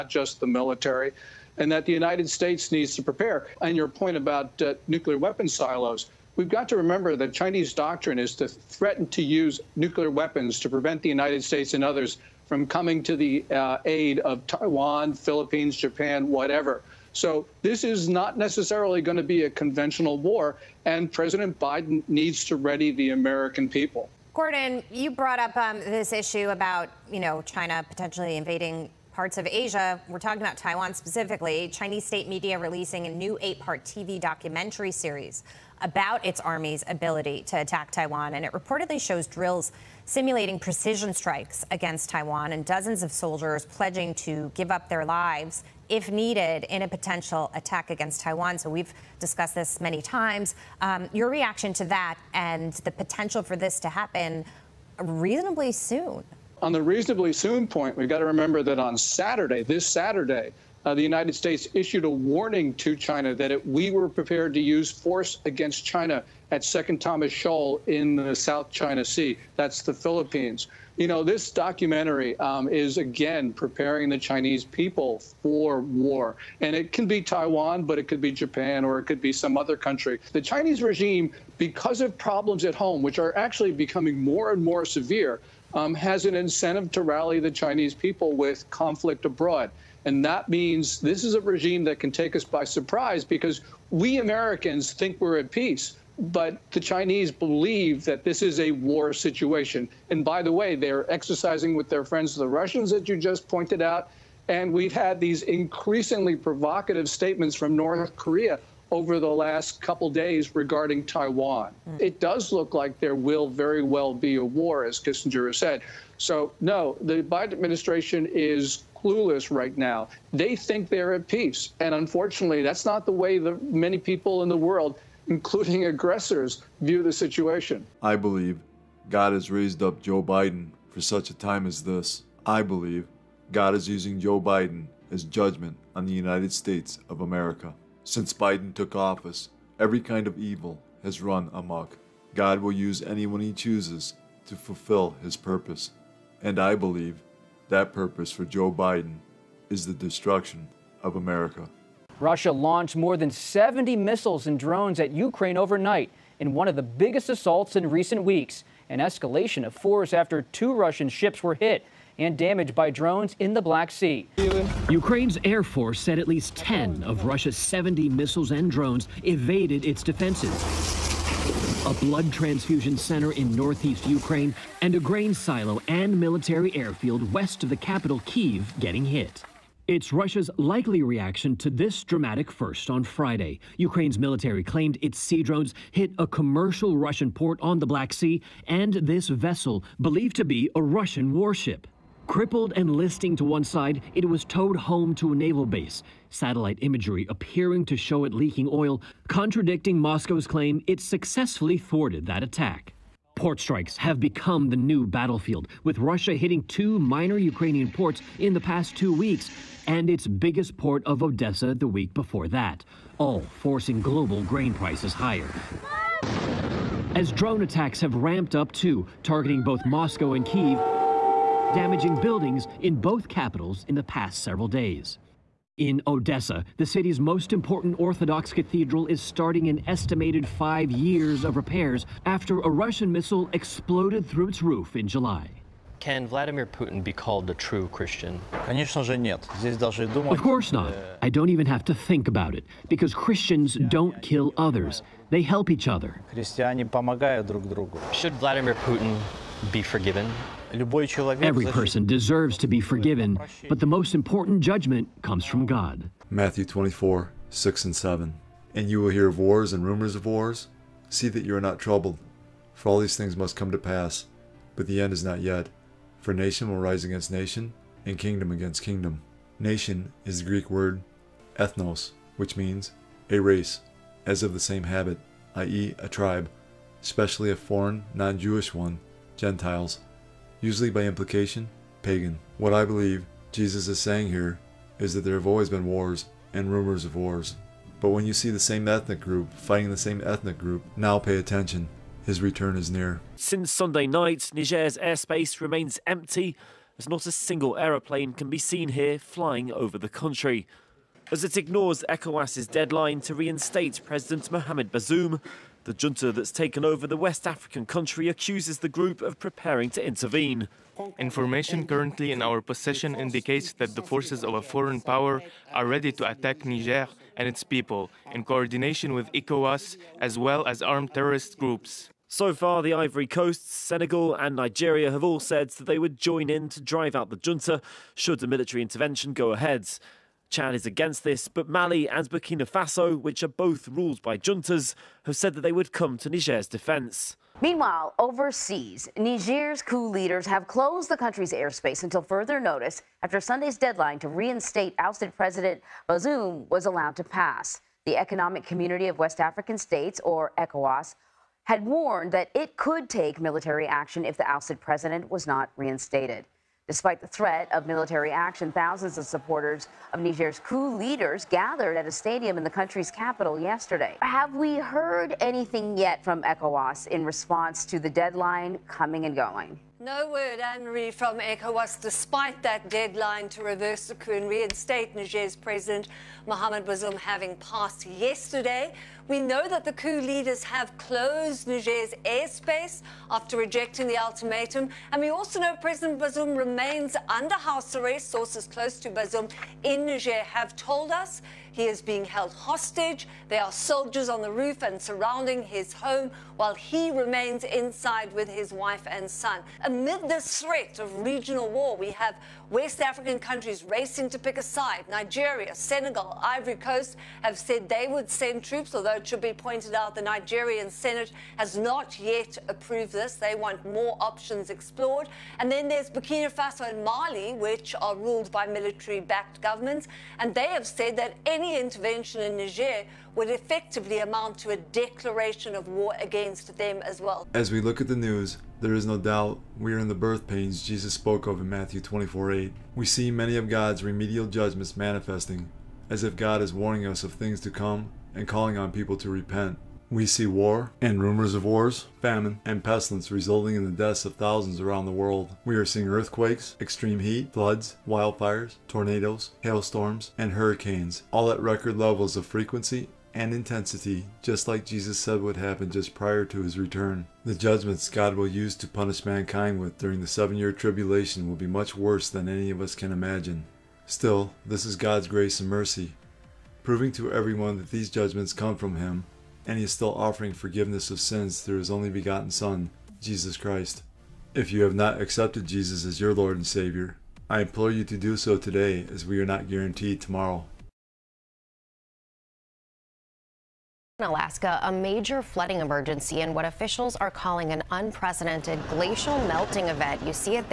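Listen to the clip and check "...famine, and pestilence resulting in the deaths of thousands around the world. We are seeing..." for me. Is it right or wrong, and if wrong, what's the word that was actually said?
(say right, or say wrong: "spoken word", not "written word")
right.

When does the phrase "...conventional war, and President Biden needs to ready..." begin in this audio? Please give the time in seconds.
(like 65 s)
19 s.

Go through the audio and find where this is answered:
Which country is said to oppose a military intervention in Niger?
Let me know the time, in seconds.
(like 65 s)
330 s.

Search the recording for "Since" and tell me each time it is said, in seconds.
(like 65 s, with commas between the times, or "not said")
138 s, 293 s.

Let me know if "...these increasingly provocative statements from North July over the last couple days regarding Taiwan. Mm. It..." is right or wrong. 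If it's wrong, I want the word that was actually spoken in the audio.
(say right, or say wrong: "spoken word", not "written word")
wrong: "Korea", not "July".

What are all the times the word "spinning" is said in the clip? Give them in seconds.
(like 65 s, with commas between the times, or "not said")
not said.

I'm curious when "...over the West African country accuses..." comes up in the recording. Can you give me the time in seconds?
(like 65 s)
306 s.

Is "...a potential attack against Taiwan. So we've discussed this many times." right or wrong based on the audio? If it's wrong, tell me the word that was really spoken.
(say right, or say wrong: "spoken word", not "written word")
right.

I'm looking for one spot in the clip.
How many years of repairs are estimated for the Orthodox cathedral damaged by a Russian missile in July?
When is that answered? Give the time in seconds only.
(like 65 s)
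230 s.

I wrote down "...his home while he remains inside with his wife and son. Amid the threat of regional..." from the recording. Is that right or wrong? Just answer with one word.
right.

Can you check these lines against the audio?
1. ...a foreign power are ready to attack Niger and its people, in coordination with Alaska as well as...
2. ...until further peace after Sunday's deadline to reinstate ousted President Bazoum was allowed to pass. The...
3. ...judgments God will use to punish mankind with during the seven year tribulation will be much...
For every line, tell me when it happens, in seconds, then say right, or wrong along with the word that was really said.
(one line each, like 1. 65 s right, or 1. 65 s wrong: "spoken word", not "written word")
1. 314 s wrong: "ECOWAS", not "Alaska"
2. 342 s wrong: "notice", not "peace"
3. 457 s right.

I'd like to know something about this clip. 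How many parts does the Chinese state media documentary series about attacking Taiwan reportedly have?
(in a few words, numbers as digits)
8.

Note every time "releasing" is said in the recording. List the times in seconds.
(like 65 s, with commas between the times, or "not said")
32 s.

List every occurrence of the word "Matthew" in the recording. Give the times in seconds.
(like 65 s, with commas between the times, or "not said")
256 s, 431 s.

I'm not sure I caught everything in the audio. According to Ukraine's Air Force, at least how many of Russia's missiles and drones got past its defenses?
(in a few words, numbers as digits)
10.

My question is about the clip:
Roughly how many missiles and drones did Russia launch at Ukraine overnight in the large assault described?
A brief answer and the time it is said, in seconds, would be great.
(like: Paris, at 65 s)
More than 70, at 152 s.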